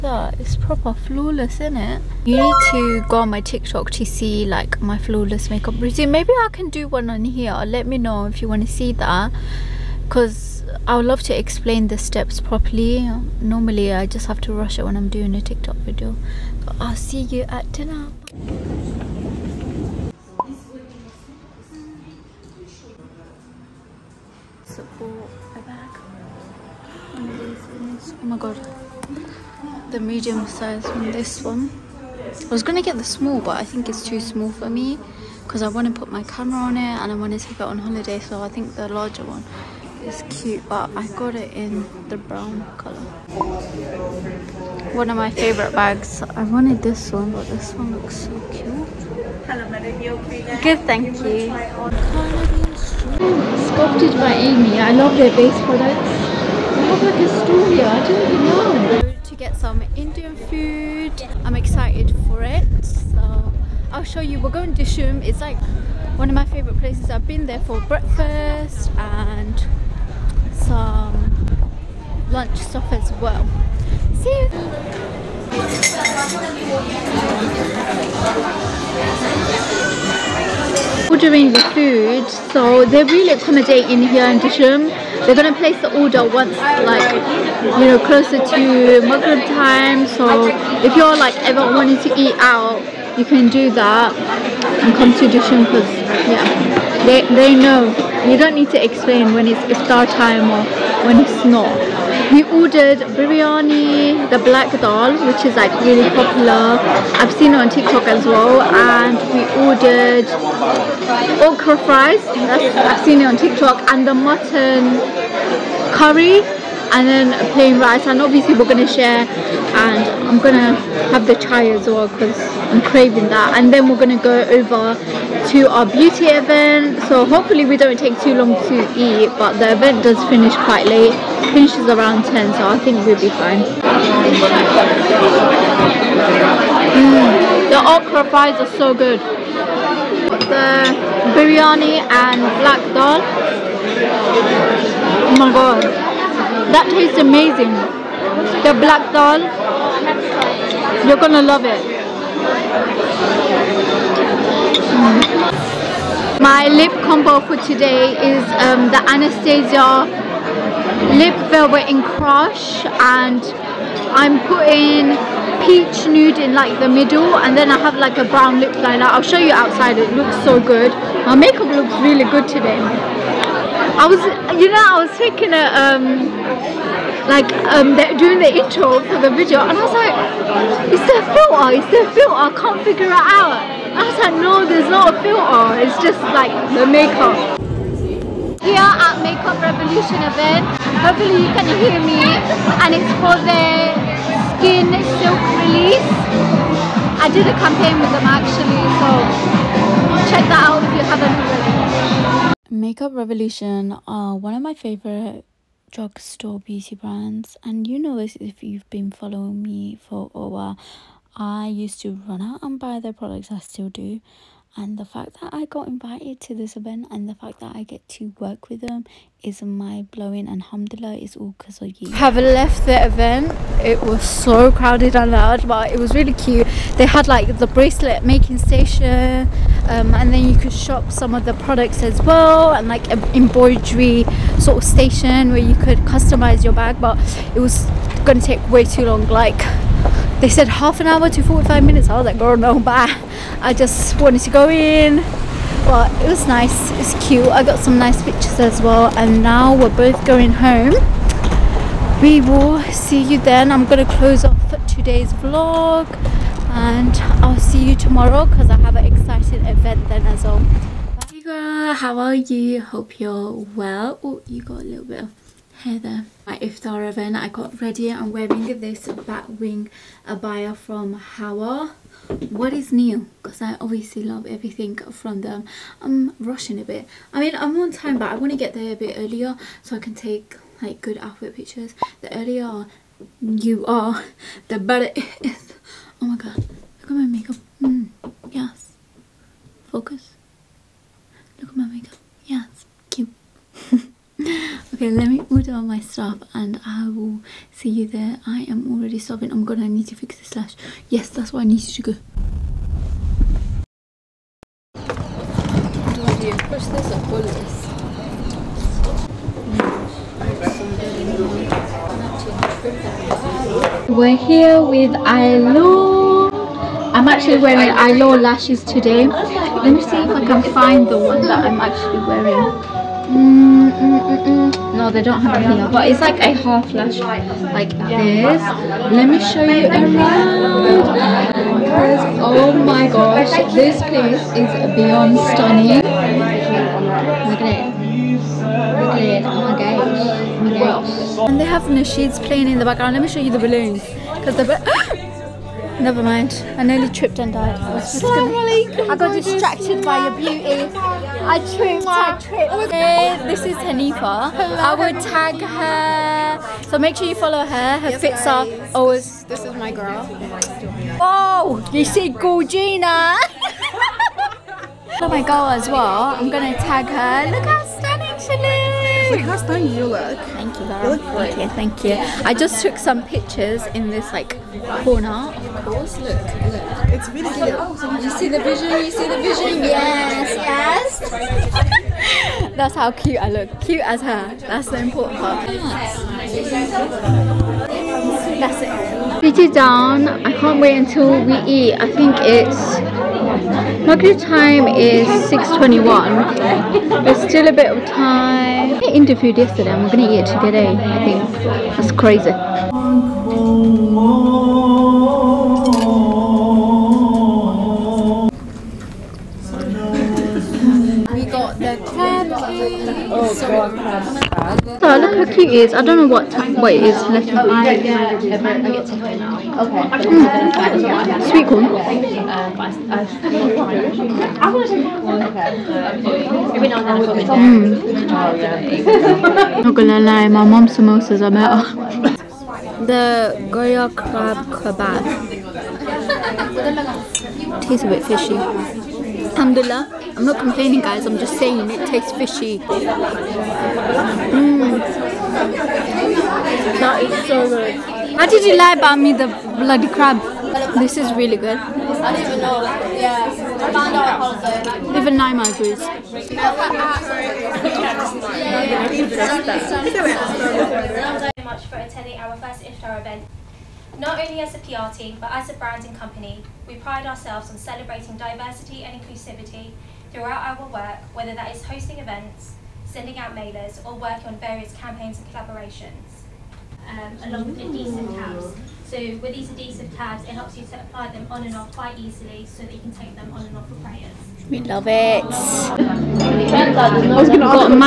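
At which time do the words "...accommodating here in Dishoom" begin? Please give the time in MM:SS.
01:23.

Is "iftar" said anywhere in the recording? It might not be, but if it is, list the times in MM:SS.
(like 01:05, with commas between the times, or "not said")
01:39, 04:26, 07:42.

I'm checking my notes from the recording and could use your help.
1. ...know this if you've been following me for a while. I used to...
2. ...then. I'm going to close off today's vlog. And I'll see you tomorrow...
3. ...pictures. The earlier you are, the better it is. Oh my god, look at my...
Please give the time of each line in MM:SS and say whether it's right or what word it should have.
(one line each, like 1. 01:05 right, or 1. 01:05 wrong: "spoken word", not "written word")
1. 03:27 right
2. 04:13 right
3. 04:41 right.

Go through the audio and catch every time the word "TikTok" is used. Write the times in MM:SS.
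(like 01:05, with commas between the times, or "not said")
00:03, 00:15, 01:47, 01:53.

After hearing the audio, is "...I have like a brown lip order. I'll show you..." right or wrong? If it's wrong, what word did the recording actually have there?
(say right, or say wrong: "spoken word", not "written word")
wrong: "liner", not "order".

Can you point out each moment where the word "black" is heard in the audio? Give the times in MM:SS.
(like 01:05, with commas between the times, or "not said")
01:44, 02:22, 02:28.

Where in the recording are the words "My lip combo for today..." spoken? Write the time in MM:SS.
02:36.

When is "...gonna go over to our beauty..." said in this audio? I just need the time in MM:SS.
02:03.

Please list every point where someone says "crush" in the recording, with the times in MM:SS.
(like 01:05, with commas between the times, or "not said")
02:42.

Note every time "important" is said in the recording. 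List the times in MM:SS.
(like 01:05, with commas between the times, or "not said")
06:24.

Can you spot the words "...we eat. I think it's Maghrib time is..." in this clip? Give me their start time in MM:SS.
06:31.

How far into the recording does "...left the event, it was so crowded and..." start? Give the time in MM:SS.
03:42.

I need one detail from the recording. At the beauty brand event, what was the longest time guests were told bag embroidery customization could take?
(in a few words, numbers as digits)
45 minutes.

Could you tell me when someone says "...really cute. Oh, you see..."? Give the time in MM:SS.
06:17.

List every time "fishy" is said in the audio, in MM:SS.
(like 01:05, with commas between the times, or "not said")
07:18, 07:22.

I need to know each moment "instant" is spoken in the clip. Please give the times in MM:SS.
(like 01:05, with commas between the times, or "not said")
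not said.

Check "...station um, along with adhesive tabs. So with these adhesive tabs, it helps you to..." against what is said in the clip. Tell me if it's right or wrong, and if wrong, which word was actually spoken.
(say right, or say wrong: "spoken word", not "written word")
wrong: "collaboration", not "station".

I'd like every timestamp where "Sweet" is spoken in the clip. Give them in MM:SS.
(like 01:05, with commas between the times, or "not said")
07:01.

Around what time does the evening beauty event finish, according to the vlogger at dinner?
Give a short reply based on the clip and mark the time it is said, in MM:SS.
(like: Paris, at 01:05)
10, at 02:12.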